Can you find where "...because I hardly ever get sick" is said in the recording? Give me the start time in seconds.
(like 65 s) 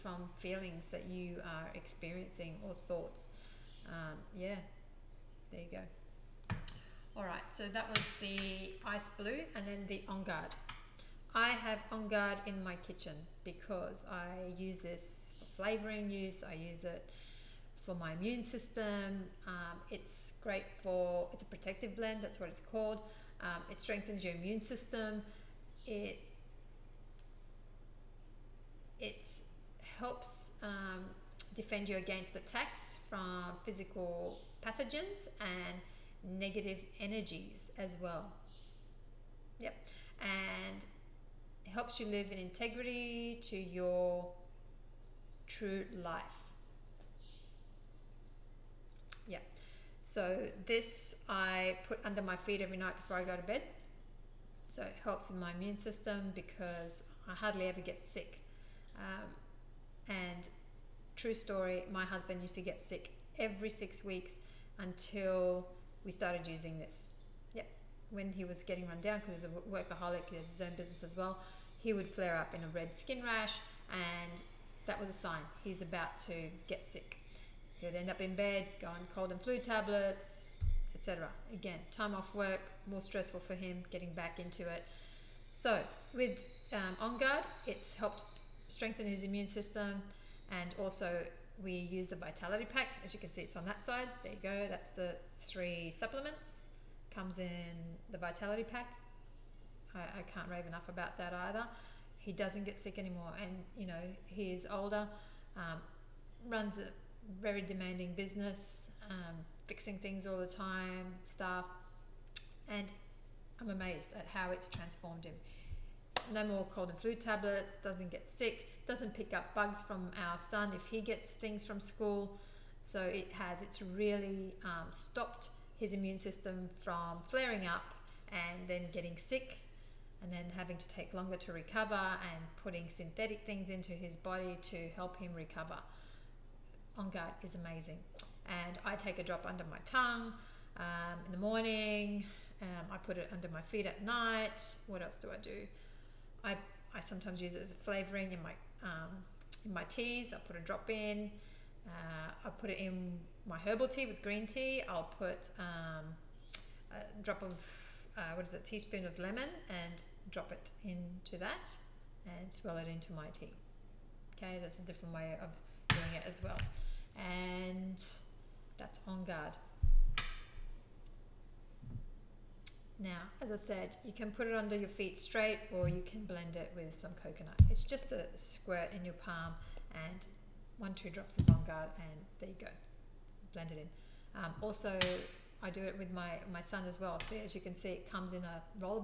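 56 s.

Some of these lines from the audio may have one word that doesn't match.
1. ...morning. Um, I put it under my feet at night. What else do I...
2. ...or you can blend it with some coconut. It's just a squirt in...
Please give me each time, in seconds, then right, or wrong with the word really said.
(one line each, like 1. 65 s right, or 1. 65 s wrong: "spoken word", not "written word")
1. 141 s right
2. 175 s right.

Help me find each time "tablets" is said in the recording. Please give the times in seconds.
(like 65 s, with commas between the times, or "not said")
79 s, 117 s.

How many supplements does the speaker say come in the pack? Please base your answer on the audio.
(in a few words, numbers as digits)
3.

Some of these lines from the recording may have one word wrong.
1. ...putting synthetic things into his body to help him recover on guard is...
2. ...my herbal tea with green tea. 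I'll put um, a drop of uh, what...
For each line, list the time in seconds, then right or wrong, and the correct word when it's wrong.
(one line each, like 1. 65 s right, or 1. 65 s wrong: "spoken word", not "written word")
1. 132 s right
2. 153 s right.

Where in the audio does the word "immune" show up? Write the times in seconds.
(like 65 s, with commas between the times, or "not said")
18 s, 24 s, 55 s, 89 s, 125 s.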